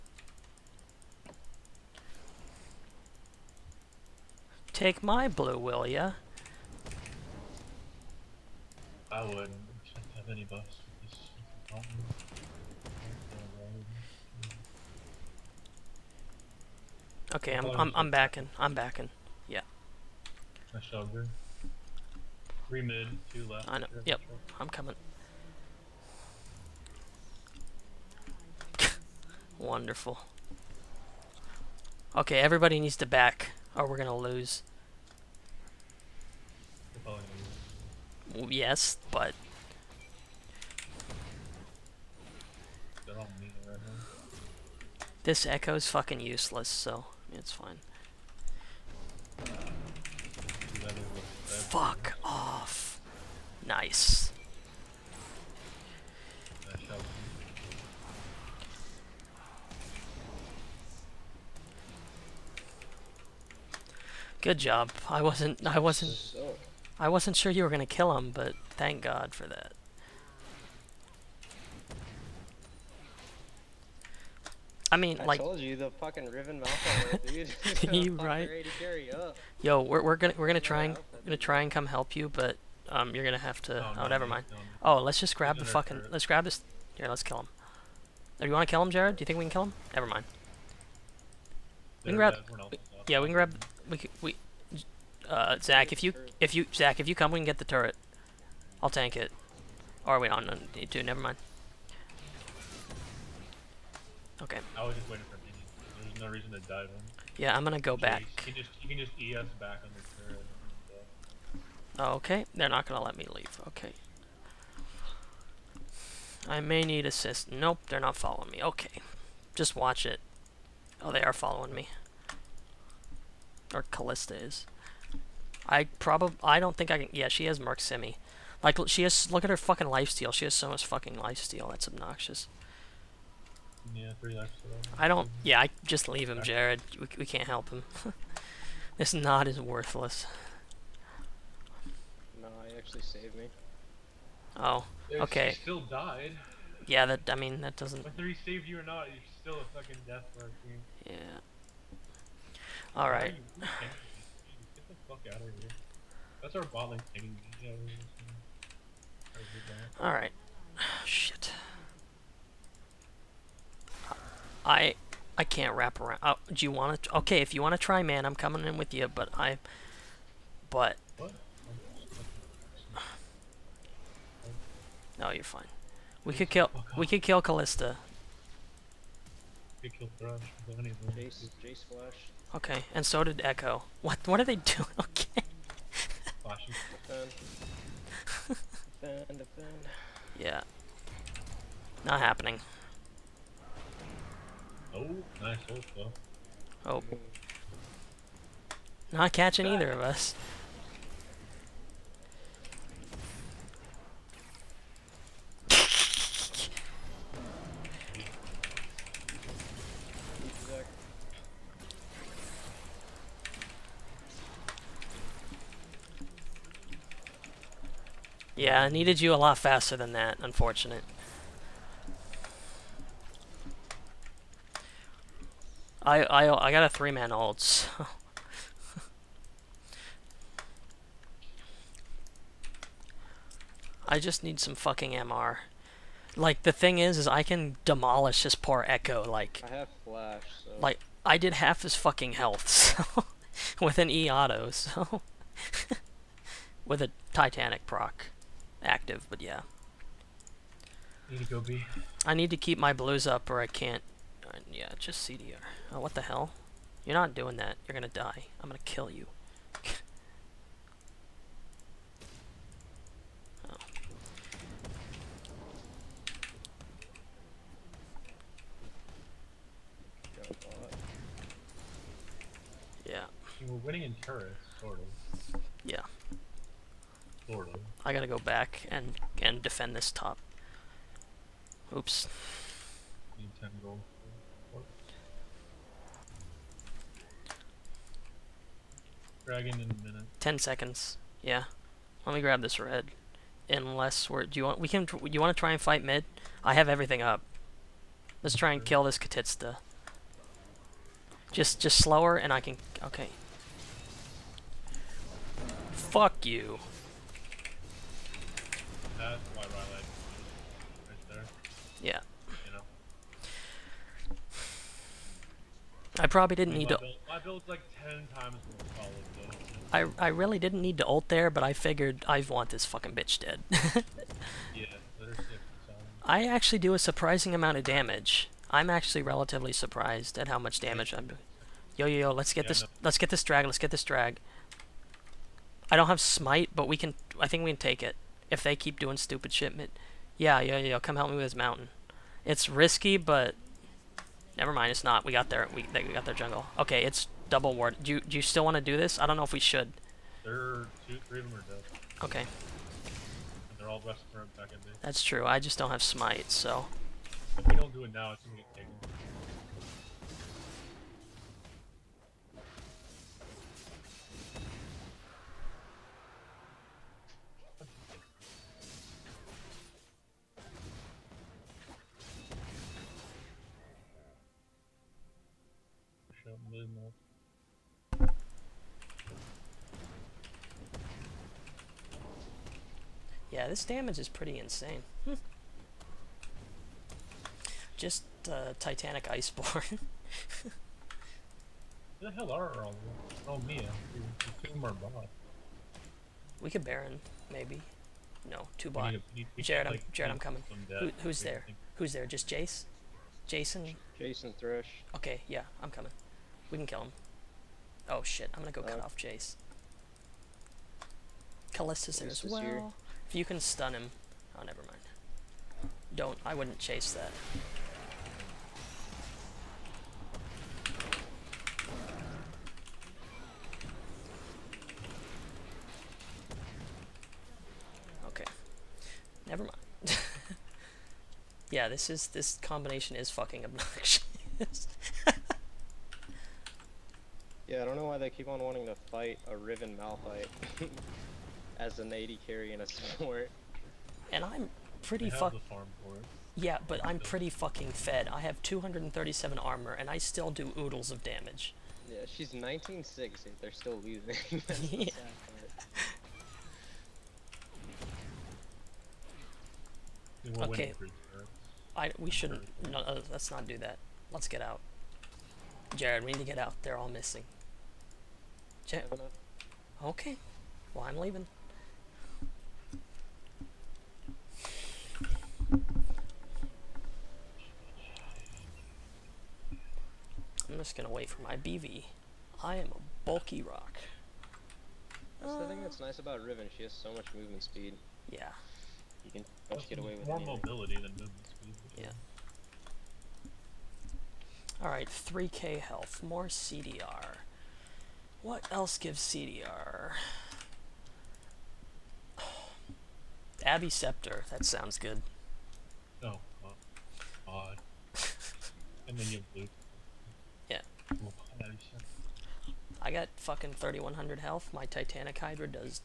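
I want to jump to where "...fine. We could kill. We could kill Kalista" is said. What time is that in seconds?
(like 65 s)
175 s.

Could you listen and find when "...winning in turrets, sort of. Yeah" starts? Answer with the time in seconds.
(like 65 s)
273 s.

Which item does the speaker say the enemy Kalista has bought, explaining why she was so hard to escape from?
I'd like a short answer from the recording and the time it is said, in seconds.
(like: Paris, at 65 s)
Merc Scim, at 127 s.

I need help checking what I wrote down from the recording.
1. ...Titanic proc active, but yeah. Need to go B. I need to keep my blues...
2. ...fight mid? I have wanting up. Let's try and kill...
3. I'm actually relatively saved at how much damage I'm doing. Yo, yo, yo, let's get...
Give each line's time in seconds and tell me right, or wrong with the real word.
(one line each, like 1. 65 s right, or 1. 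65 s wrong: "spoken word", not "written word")
1. 247 s right
2. 295 s wrong: "everything", not "wanting"
3. 328 s wrong: "surprised", not "saved".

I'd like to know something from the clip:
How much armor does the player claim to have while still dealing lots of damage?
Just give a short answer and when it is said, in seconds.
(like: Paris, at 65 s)
237, at 448 s.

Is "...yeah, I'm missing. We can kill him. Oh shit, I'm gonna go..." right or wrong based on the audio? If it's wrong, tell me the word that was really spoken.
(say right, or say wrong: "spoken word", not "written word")
wrong: "coming", not "missing".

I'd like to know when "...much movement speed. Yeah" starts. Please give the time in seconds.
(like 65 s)
487 s.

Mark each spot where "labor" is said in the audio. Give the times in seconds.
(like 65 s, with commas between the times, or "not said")
not said.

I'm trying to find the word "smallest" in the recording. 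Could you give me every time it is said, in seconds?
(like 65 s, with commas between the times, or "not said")
not said.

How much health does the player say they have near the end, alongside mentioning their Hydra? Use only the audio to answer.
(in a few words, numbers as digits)
3100.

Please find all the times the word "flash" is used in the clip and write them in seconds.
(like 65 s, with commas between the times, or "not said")
181 s, 240 s.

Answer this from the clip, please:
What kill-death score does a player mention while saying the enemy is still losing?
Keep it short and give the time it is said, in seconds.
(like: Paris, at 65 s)
19-6, at 452 s.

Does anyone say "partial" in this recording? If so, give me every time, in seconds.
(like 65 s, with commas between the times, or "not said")
not said.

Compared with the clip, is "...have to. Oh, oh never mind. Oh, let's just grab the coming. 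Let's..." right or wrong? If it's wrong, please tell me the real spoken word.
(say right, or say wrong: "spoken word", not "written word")
wrong: "fucking", not "coming".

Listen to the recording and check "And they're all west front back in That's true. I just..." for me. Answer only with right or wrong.
right.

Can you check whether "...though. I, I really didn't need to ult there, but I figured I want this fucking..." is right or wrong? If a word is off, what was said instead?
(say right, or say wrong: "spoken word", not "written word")
right.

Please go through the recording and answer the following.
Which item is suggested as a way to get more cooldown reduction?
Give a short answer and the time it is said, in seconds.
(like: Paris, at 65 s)
Abbey Scepter, at 503 s.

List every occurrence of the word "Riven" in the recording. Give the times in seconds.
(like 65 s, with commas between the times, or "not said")
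76 s, 439 s, 486 s.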